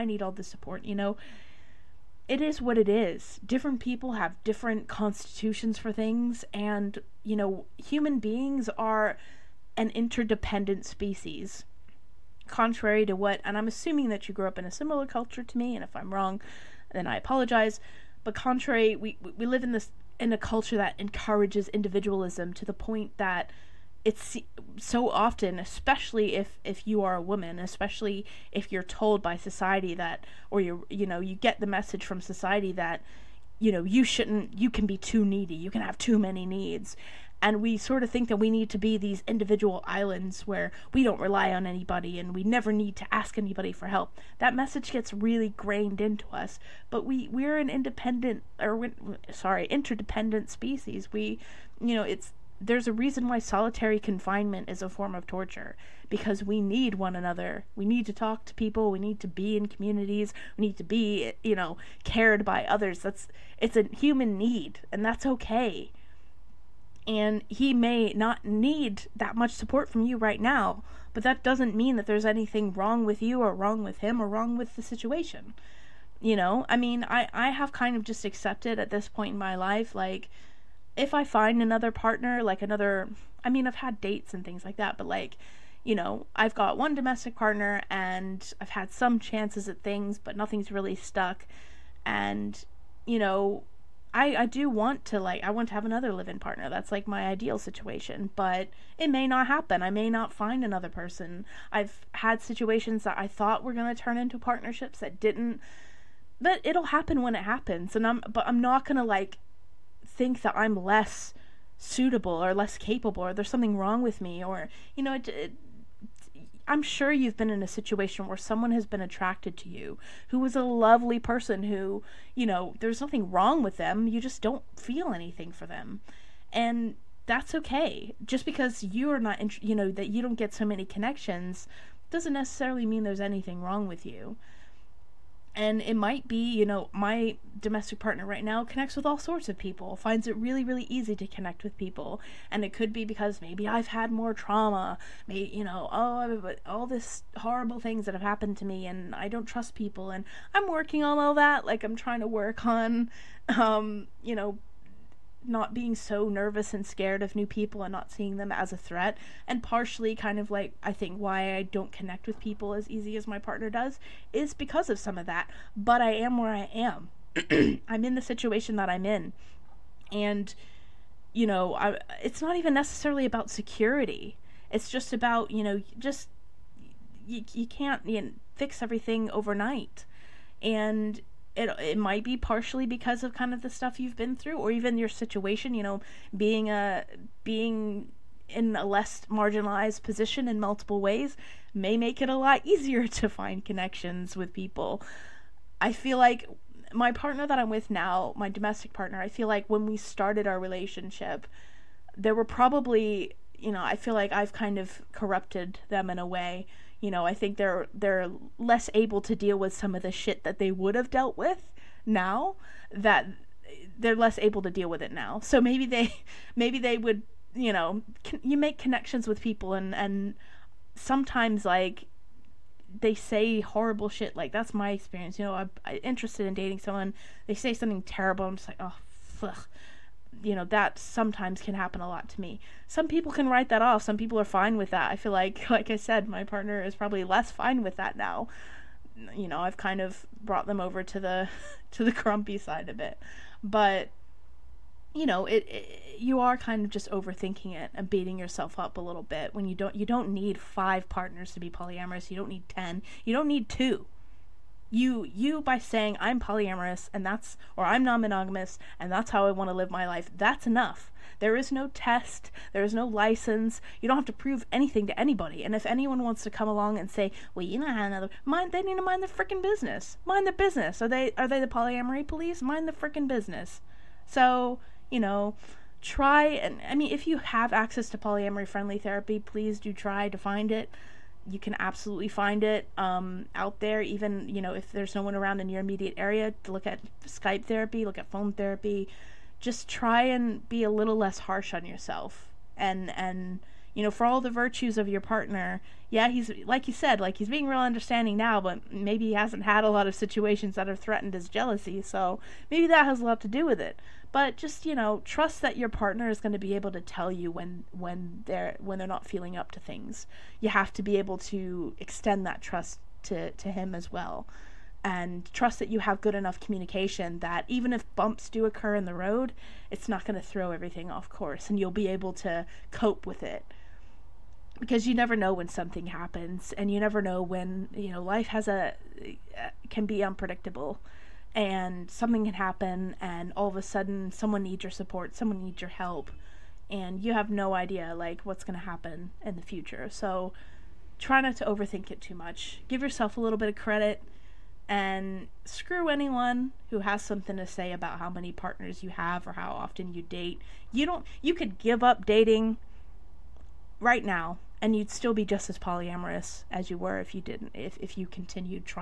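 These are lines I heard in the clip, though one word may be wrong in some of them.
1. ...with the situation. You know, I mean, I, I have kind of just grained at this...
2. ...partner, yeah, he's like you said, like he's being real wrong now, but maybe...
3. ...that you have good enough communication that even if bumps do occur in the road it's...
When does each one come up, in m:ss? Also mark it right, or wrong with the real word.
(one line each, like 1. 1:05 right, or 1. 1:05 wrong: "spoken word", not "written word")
1. 1:14 wrong: "accepted", not "grained"
2. 4:55 wrong: "understanding", not "wrong"
3. 5:15 right.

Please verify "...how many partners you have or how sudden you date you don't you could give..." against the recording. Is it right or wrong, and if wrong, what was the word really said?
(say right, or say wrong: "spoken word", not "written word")
wrong: "often", not "sudden".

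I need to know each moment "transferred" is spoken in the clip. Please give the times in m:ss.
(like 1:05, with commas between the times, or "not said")
not said.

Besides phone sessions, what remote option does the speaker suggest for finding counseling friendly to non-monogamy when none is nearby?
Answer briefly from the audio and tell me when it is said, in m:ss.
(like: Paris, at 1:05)
Skype therapy, at 4:47.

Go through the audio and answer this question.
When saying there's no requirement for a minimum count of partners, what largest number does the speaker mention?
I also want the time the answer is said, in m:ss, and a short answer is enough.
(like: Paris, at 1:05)
10, at 4:12.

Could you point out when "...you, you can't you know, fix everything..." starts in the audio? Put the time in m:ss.
2:57.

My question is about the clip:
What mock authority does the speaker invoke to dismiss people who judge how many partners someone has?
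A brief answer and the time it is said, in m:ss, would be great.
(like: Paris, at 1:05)
Polyamory police, at 4:31.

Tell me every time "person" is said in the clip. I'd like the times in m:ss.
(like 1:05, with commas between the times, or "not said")
1:40, 2:01.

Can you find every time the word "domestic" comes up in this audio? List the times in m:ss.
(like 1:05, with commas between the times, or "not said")
1:26, 2:17, 3:18.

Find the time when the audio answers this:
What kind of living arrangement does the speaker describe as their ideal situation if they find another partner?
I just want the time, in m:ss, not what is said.
1:36.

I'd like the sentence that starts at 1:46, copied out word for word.
But it'll happen when it happens.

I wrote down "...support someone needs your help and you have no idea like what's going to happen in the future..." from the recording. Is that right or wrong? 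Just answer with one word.
right.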